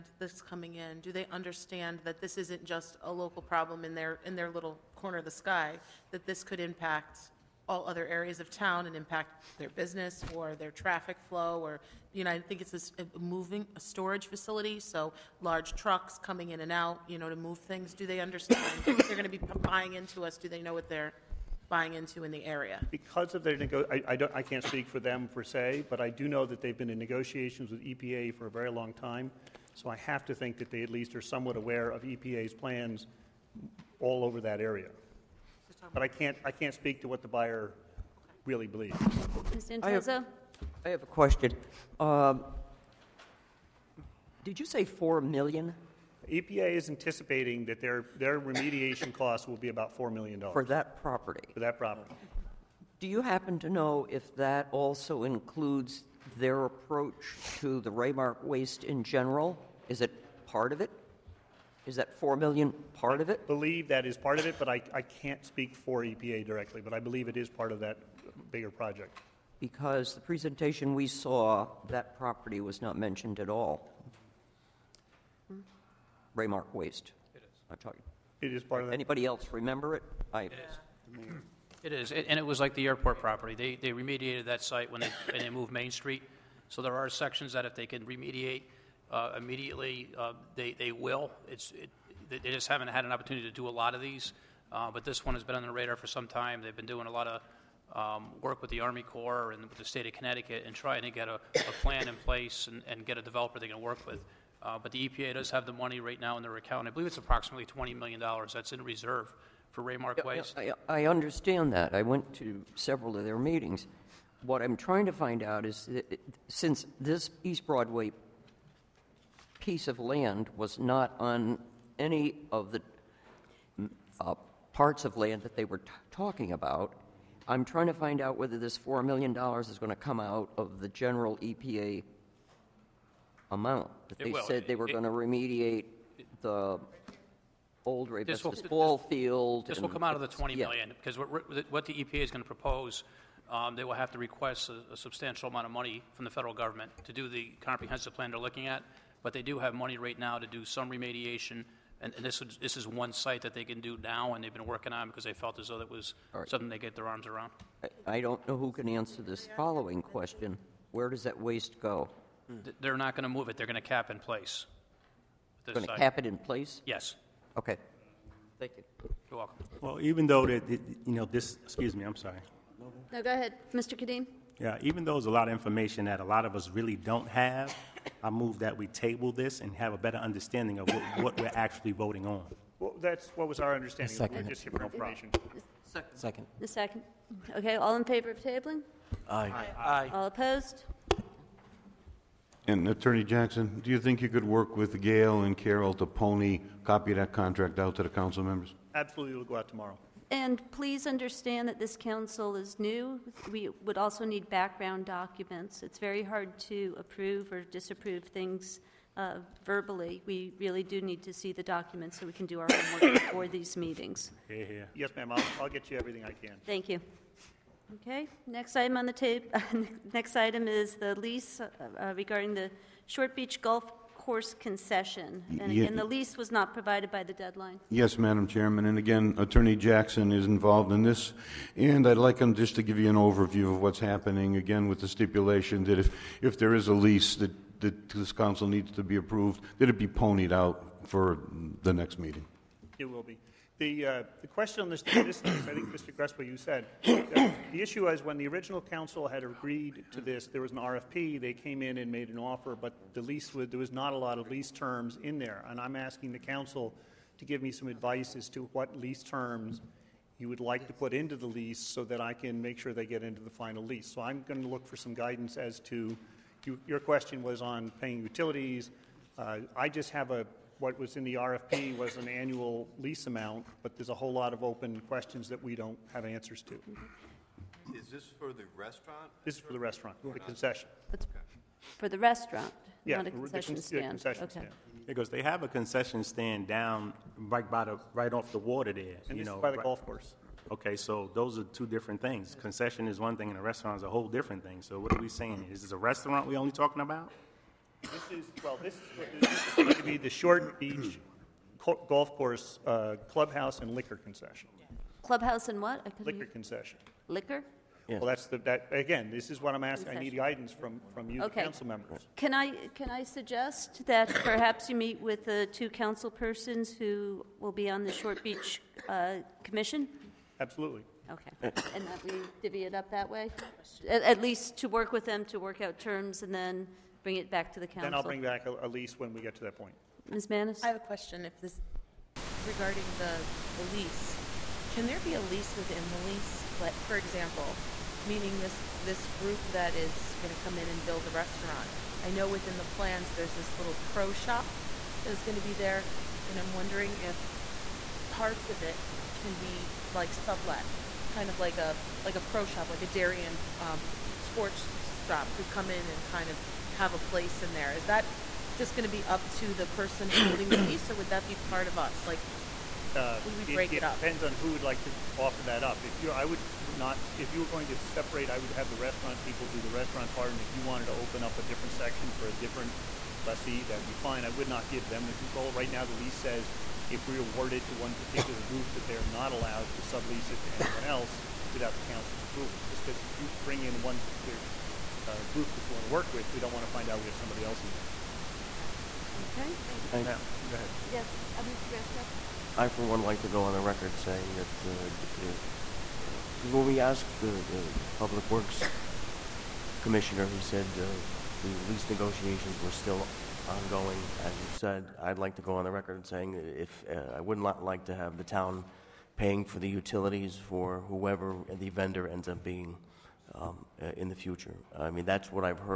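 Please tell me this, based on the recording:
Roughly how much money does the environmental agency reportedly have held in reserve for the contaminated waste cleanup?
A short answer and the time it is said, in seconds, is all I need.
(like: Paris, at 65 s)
$20 million, at 107 s.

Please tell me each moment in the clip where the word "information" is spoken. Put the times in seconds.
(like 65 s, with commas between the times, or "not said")
175 s, 184 s.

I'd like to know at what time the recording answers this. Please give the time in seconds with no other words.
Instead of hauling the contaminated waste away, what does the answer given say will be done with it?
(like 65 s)
163 s.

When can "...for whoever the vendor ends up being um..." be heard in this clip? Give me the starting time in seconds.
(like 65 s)
410 s.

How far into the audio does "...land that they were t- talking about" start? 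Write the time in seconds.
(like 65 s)
125 s.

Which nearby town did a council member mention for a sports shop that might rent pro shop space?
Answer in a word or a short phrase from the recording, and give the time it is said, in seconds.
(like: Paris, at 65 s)
Darien, at 353 s.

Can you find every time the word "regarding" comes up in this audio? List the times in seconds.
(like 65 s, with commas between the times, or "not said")
222 s, 332 s.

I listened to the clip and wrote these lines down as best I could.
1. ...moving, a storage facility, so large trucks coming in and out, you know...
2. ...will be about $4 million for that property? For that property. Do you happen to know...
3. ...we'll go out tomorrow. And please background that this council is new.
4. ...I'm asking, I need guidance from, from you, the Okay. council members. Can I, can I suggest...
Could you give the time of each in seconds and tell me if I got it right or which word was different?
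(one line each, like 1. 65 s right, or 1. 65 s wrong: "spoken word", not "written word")
1. 13 s right
2. 49 s right
3. 199 s wrong: "understand", not "background"
4. 309 s right.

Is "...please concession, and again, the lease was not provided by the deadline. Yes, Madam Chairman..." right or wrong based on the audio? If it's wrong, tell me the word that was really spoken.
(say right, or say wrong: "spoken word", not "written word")
wrong: "course", not "please".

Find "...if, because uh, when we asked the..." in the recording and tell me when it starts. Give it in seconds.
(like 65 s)
395 s.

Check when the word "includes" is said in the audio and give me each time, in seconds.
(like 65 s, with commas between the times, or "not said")
55 s.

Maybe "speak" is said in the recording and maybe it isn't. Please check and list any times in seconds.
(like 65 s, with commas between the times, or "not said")
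24 s, 36 s, 65 s.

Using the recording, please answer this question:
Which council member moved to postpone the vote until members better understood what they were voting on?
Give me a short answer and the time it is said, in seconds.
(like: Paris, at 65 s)
Mr. Kadeem, at 173 s.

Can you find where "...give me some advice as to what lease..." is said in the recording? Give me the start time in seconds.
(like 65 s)
257 s.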